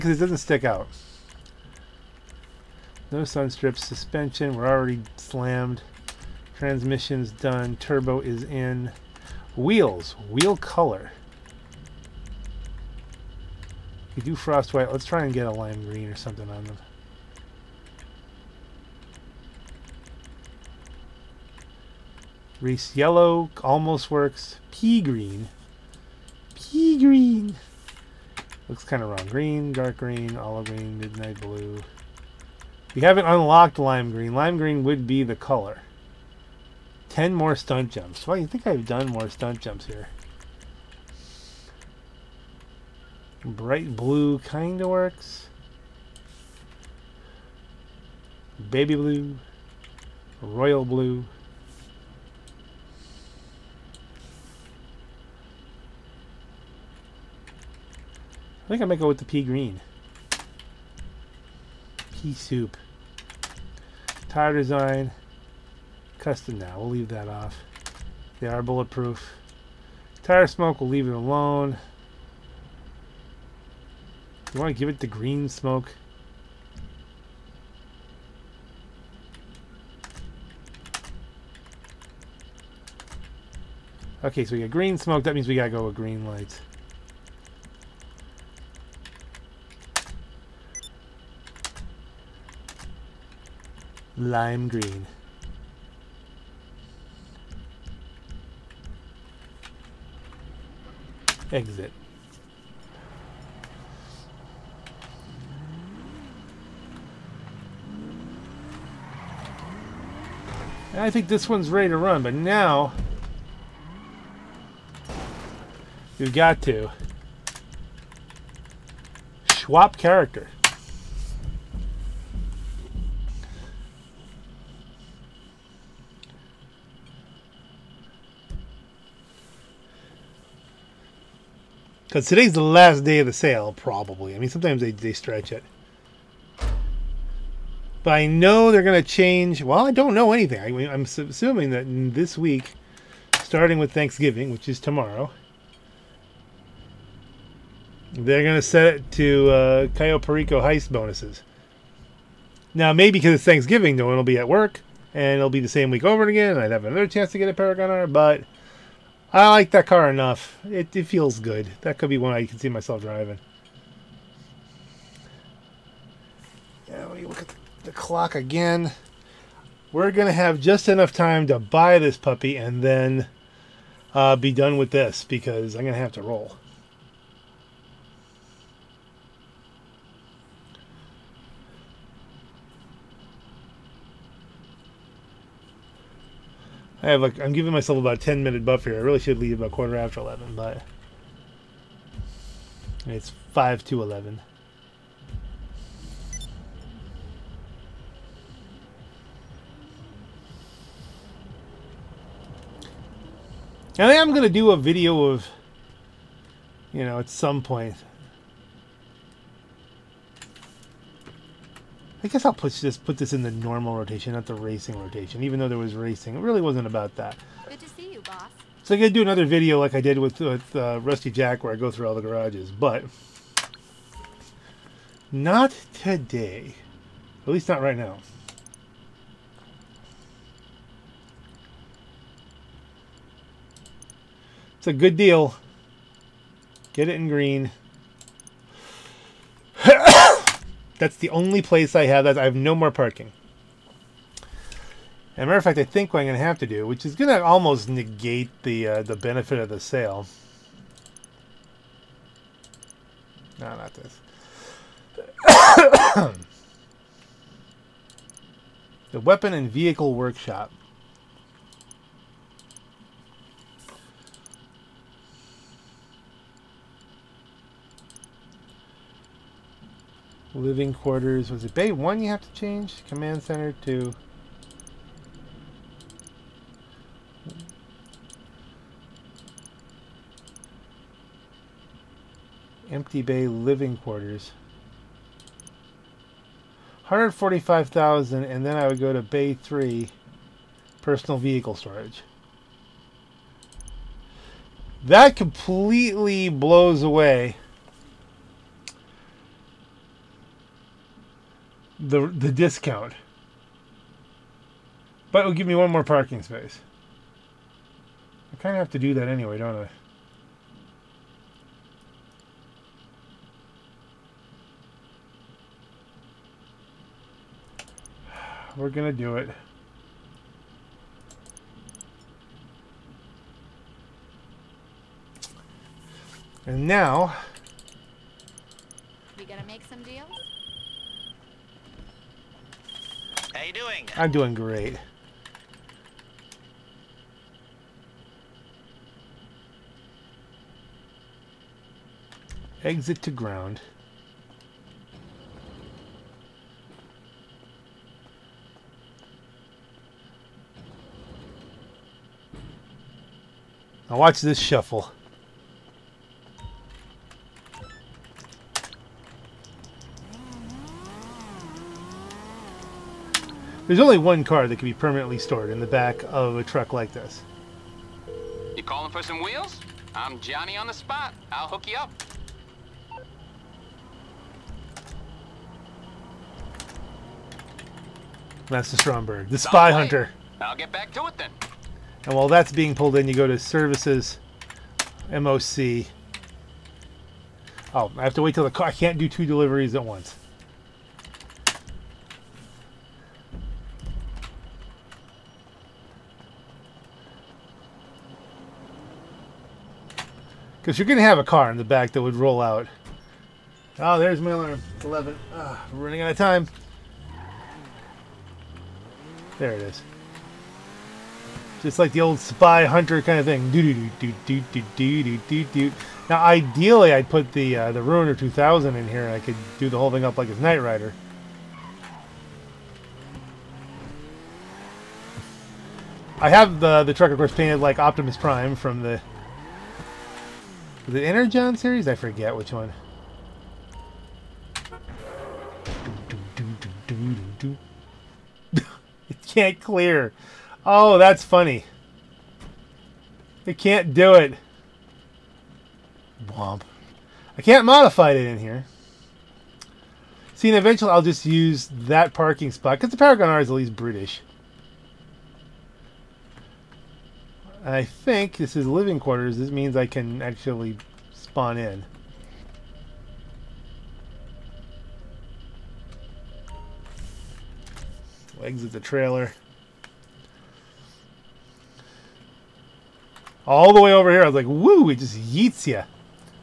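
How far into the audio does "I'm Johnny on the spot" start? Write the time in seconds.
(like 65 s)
370 s.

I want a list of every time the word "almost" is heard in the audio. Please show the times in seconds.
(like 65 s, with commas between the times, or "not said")
23 s, 247 s.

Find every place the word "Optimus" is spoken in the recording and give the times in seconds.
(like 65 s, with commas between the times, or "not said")
427 s.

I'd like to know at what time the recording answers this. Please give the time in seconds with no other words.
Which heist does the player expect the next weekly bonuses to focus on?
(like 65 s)
149 s.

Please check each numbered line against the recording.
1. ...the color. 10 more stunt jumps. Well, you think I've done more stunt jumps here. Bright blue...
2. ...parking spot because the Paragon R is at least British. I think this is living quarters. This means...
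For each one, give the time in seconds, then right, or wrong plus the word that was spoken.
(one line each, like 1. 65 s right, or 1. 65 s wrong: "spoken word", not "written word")
1. 35 s right
2. 452 s right.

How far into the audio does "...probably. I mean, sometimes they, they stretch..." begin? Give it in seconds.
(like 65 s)
133 s.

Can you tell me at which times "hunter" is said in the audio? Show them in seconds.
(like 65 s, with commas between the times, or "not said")
379 s, 412 s.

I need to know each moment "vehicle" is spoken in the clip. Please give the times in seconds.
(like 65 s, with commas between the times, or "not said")
259 s, 291 s.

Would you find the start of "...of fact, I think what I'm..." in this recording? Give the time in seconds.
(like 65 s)
245 s.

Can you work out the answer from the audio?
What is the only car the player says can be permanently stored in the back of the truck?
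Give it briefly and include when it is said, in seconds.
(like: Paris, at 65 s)
Stromberg, at 378 s.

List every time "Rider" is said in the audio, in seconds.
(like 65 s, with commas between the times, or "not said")
420 s.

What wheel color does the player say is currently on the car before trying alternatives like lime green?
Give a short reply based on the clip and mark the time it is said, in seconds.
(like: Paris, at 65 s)
Frost white, at 14 s.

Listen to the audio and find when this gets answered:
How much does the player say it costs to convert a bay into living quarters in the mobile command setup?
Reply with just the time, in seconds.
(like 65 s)
287 s.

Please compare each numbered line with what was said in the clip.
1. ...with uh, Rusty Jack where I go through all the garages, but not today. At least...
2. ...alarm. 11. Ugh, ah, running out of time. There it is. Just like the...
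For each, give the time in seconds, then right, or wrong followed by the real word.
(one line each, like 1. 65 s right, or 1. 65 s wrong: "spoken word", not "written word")
1. 220 s right
2. 404 s right.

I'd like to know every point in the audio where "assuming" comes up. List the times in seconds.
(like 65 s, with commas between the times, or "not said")
141 s.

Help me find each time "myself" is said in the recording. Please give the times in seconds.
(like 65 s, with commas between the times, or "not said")
162 s, 187 s.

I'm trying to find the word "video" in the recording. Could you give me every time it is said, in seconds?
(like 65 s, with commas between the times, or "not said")
204 s, 219 s.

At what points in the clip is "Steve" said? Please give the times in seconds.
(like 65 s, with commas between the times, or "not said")
not said.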